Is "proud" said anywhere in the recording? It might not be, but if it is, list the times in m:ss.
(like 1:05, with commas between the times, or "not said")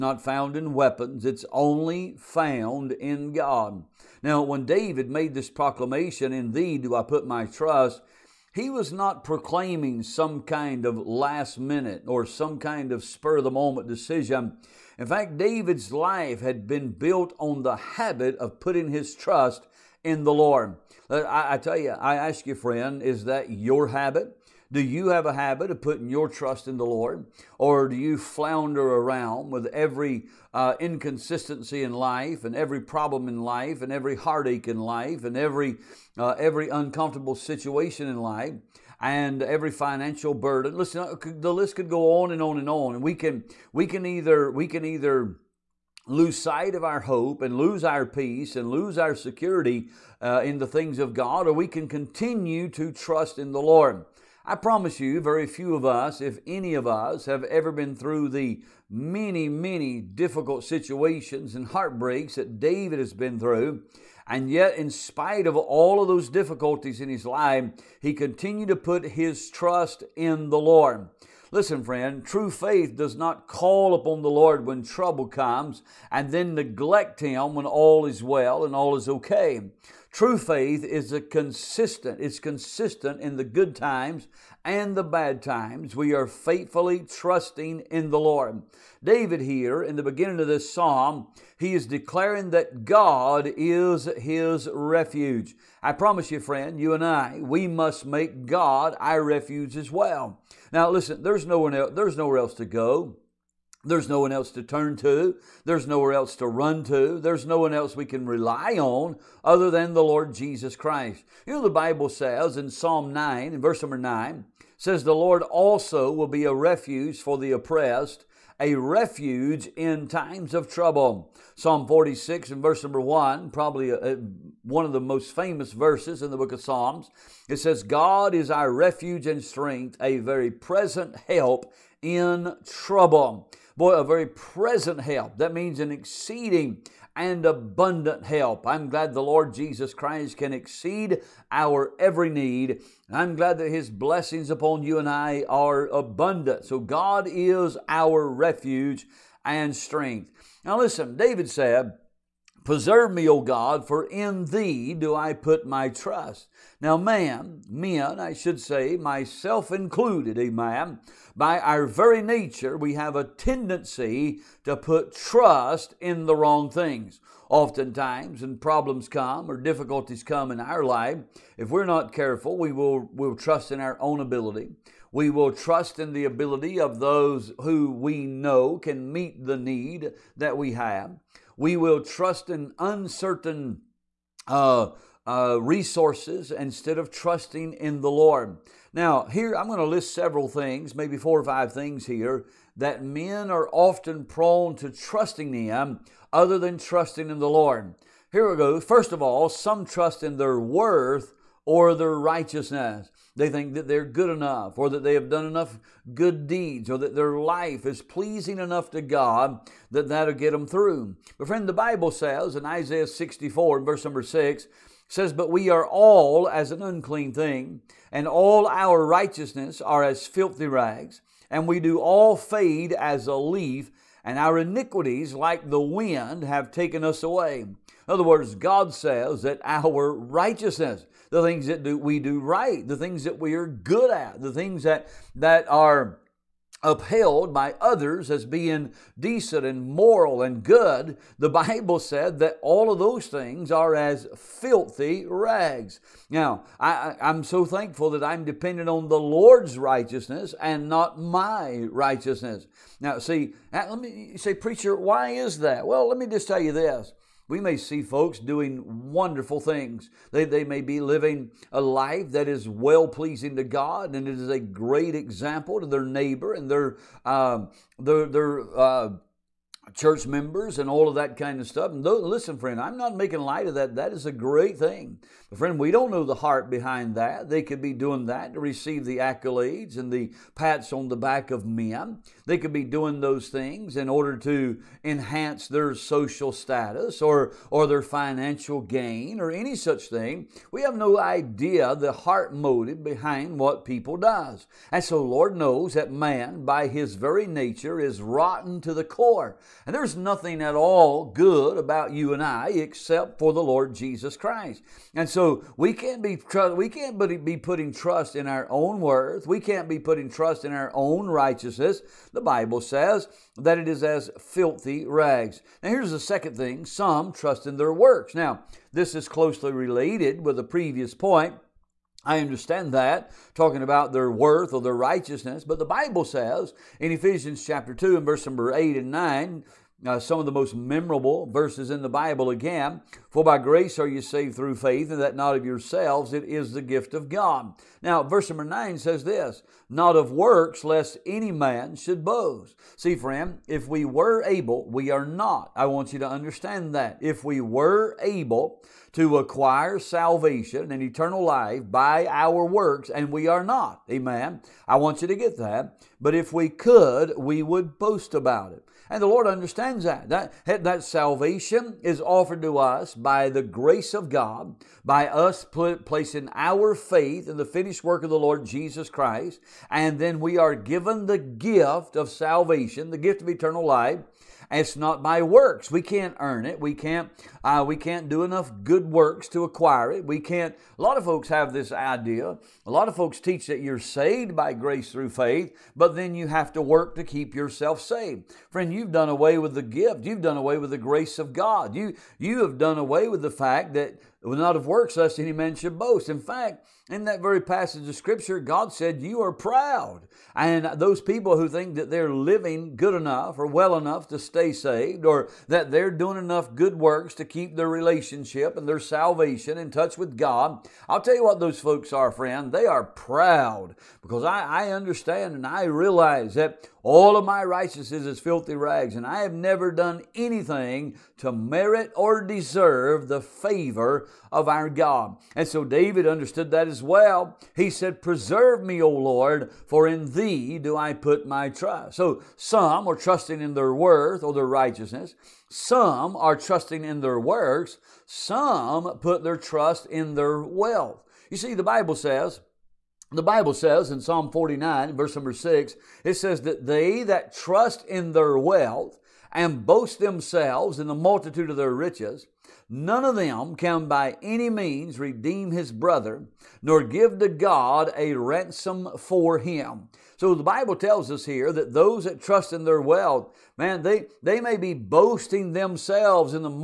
6:39, 6:53.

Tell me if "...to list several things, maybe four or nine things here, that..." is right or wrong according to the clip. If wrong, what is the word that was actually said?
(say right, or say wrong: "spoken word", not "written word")
wrong: "five", not "nine".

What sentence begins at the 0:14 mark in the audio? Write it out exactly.
In fact, David's life had been built on the habit of putting his trust in the Lord.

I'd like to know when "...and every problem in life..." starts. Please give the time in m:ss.
0:32.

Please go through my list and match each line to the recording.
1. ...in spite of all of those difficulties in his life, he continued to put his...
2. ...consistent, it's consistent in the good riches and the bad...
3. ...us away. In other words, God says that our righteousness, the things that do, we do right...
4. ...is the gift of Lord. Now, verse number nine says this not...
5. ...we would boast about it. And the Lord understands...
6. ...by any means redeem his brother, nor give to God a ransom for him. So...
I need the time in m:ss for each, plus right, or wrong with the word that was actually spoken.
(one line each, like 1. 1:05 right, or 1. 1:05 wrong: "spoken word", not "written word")
1. 1:04 right
2. 1:21 wrong: "times", not "riches"
3. 3:47 right
4. 5:36 wrong: "God", not "Lord"
5. 5:57 right
6. 7:34 right.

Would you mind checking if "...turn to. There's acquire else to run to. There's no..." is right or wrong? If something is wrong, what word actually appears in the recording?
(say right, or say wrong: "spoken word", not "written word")
wrong: "nowhere", not "acquire".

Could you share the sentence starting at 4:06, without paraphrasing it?
Now, I, am so thankful that I'm dependent on the Lord's righteousness and not my righteousness.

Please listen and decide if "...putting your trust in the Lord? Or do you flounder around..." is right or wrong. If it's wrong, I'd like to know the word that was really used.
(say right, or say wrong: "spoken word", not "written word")
right.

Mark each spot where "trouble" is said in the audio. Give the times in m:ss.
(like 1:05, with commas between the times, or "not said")
1:14, 2:00, 2:12.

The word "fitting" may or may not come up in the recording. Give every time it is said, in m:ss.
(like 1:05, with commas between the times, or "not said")
not said.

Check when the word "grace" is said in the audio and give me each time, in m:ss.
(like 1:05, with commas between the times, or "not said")
5:33, 6:03, 6:24, 6:30.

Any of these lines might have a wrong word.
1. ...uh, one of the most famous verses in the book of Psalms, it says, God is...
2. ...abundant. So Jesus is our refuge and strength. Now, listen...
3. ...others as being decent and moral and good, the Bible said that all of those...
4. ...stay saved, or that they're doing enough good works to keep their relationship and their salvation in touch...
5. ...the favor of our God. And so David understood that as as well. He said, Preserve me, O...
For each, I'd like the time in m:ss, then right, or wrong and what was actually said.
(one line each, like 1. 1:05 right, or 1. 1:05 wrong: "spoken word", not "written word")
1. 2:04 right
2. 2:25 wrong: "God", not "Jesus"
3. 3:57 right
4. 6:44 right
5. 7:03 right.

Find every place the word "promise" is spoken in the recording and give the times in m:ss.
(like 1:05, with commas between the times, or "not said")
0:54, 1:35.